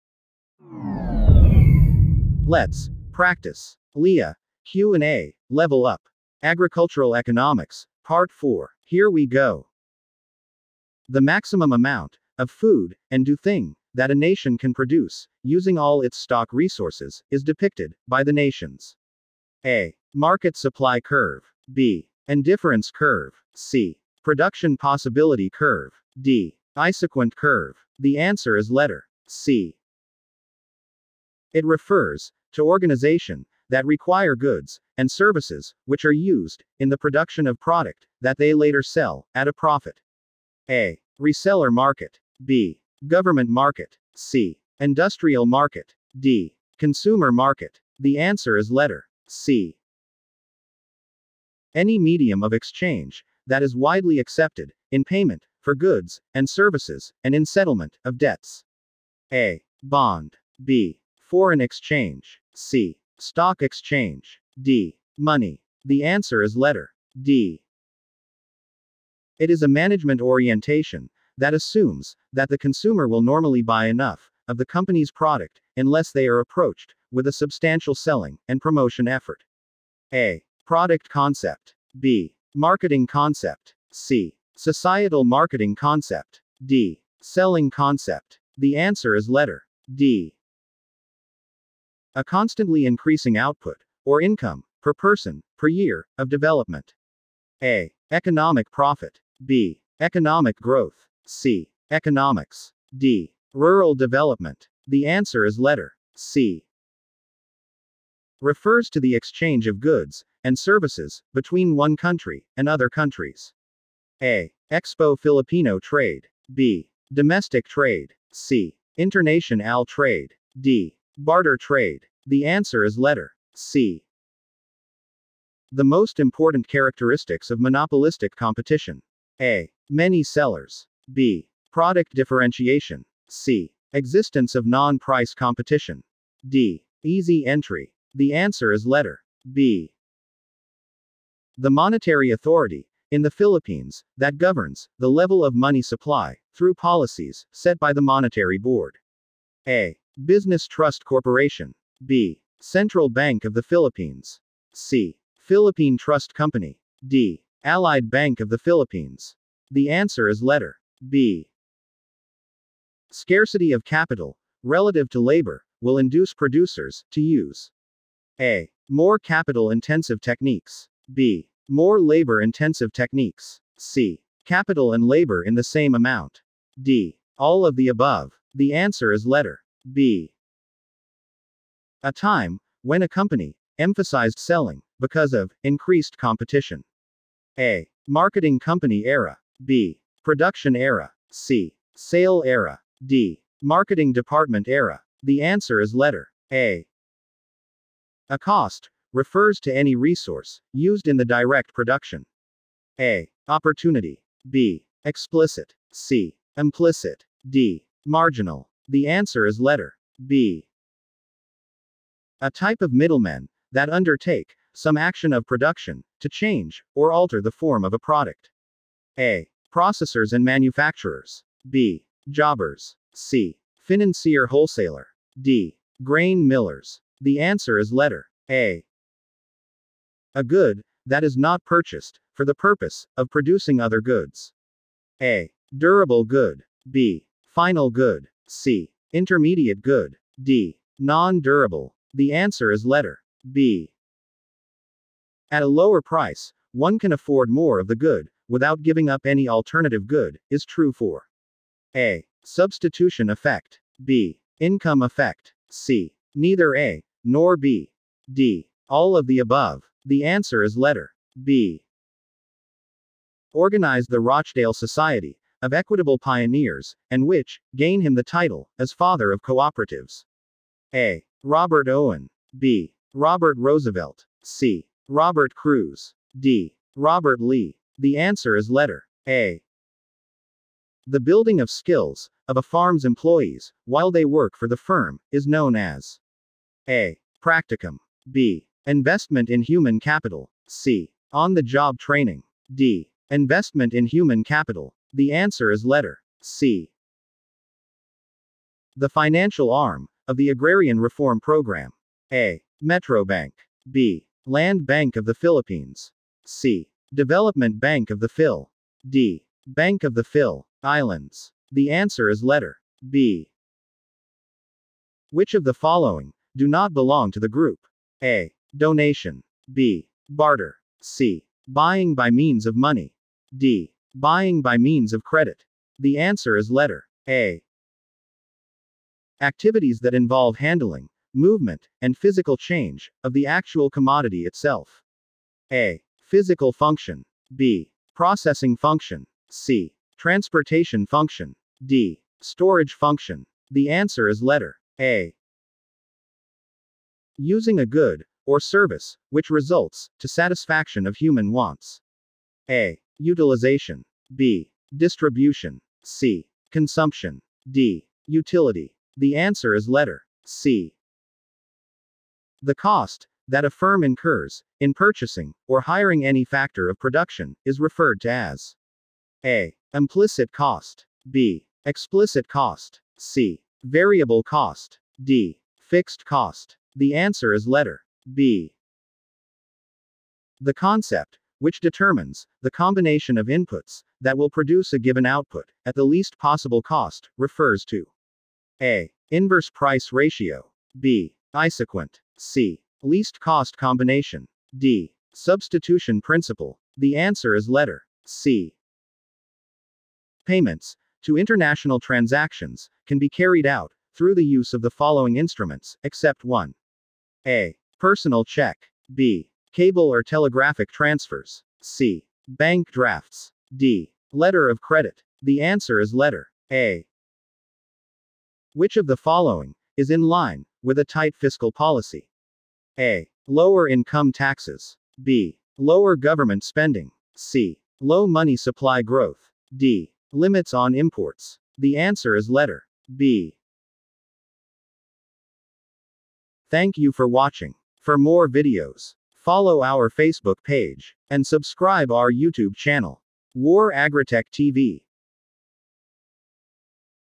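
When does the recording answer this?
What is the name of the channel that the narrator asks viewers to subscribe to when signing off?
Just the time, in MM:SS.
07:23.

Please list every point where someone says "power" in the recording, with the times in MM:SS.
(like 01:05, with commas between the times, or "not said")
not said.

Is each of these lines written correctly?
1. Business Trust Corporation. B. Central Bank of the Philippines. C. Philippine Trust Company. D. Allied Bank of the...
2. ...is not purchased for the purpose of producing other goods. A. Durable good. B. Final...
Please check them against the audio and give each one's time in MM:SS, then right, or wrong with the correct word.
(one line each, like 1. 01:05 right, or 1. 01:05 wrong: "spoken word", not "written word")
1. 02:30 right
2. 03:51 right.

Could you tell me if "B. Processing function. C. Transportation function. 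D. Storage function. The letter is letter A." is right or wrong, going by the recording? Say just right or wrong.
wrong.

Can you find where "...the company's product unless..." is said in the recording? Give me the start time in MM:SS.
01:14.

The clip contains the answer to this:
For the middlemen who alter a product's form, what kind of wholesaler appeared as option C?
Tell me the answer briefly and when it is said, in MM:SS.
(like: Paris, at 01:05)
Financier wholesaler, at 03:43.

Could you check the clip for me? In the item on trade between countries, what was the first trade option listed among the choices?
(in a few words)
Expo Filipino trade.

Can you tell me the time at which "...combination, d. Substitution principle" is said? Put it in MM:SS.
06:33.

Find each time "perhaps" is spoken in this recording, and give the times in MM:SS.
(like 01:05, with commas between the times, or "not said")
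not said.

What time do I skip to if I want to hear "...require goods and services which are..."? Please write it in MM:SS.
00:33.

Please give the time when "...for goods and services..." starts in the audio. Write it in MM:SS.
00:55.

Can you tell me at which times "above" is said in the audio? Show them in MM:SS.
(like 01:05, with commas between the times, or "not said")
02:57, 04:19.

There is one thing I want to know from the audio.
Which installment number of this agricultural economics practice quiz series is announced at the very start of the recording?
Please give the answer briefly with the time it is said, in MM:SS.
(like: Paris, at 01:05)
Part 4, at 00:08.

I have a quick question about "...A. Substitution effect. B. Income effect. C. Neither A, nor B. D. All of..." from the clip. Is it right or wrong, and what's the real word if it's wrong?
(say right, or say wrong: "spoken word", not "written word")
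right.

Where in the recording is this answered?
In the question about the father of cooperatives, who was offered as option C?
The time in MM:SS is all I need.
04:35.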